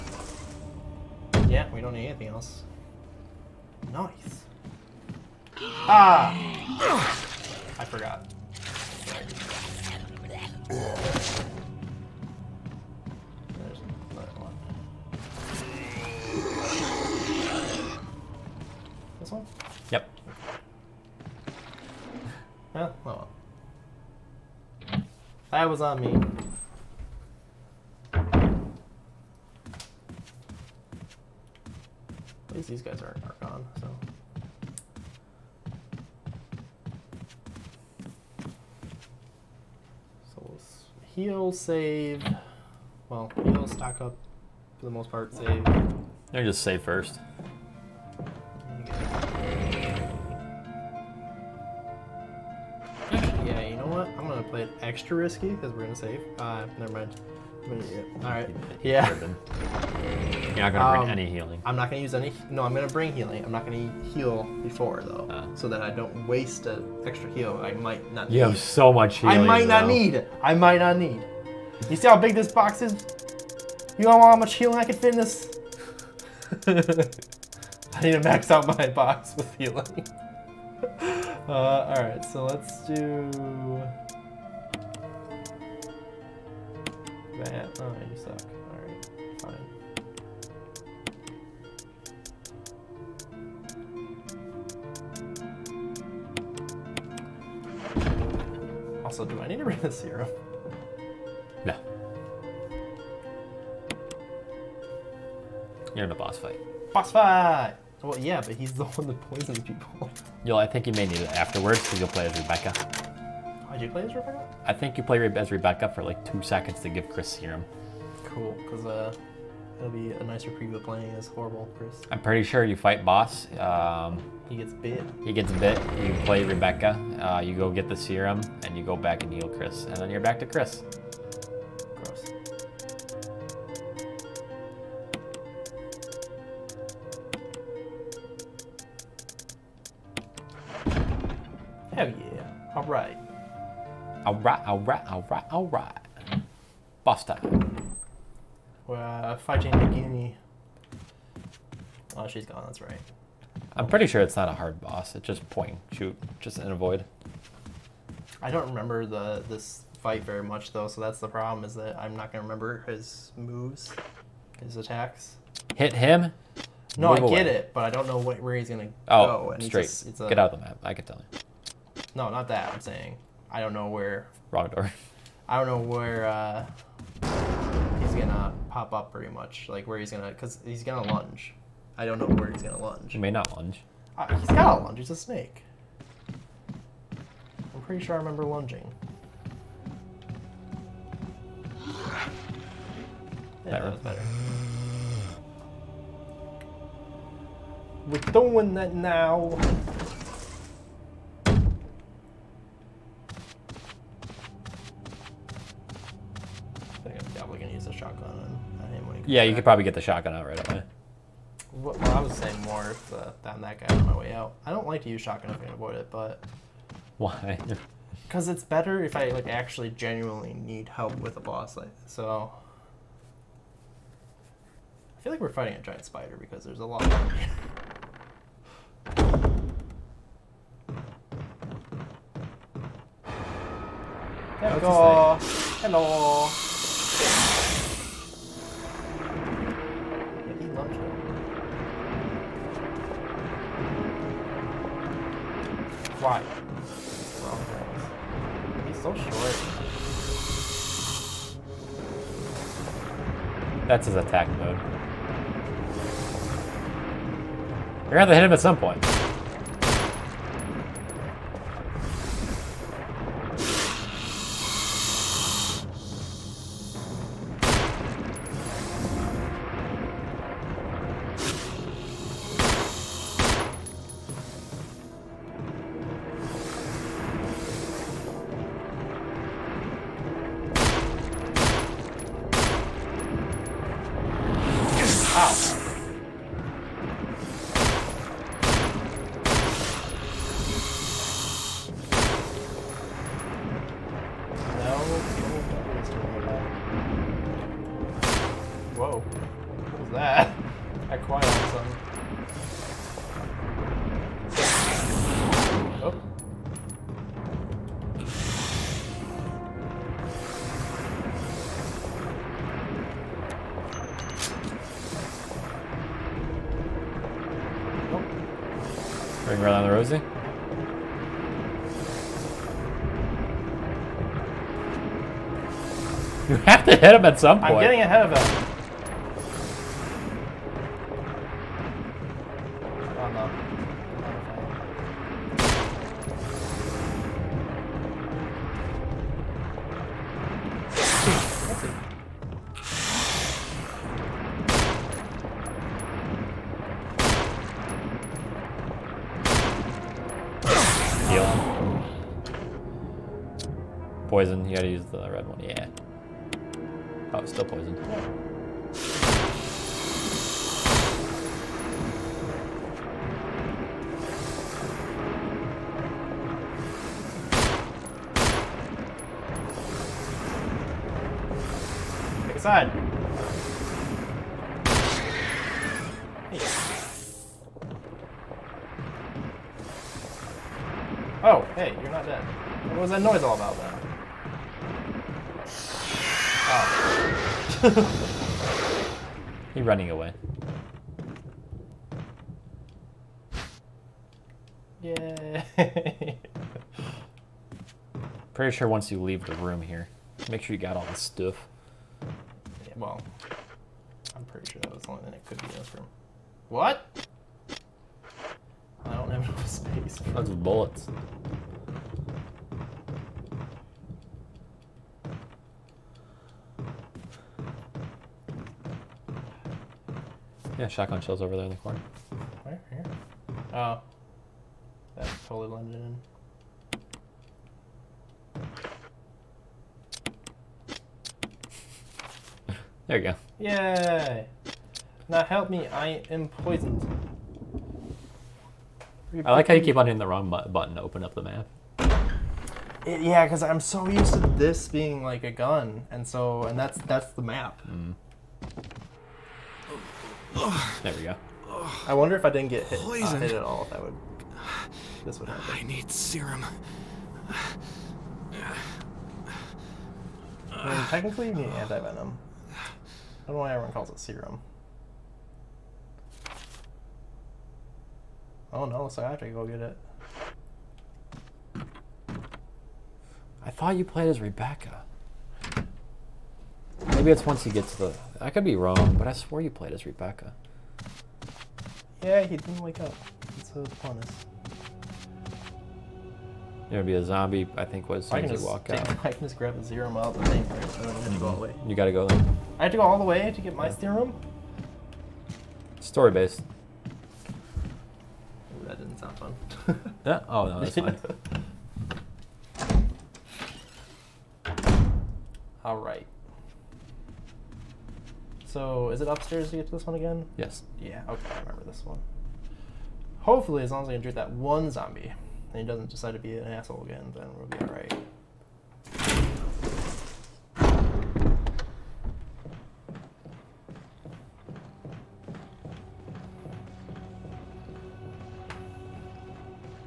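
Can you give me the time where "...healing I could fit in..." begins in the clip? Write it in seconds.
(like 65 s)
74 s.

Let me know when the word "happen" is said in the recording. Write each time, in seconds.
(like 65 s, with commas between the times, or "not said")
455 s.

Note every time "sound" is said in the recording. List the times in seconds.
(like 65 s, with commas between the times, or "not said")
499 s.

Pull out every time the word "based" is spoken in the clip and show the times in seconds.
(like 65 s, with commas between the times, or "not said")
496 s.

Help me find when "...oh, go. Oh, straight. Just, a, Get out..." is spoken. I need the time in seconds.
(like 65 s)
169 s.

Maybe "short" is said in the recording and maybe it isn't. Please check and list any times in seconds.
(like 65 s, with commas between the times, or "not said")
249 s.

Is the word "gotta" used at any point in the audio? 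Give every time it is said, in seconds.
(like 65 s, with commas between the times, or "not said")
184 s, 354 s, 491 s.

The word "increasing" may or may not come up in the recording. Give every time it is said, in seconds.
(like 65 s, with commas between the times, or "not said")
not said.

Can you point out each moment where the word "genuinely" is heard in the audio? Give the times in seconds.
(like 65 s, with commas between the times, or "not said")
219 s.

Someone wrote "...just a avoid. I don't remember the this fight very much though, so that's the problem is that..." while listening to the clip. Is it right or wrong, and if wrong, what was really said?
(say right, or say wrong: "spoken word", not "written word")
right.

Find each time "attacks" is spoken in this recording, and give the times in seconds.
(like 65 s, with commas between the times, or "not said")
164 s, 254 s.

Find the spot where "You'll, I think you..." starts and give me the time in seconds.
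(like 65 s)
110 s.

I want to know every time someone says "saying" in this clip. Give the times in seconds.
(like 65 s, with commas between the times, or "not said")
172 s, 212 s.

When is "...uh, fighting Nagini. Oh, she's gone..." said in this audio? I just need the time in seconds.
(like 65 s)
148 s.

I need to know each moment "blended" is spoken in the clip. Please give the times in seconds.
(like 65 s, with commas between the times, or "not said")
425 s.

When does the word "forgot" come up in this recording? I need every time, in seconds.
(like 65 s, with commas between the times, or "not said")
7 s.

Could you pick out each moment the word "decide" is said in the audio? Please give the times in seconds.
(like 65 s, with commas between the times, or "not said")
516 s.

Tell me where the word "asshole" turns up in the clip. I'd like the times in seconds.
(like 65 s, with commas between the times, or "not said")
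516 s.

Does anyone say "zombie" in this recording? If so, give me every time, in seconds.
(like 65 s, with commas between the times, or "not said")
487 s, 514 s.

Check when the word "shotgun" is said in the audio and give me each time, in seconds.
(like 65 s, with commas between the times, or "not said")
210 s, 215 s, 420 s.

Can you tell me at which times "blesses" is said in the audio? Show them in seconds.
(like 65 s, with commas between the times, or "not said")
not said.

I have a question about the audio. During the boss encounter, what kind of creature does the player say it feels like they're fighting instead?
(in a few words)
giant spider.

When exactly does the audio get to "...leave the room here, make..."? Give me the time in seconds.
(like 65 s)
399 s.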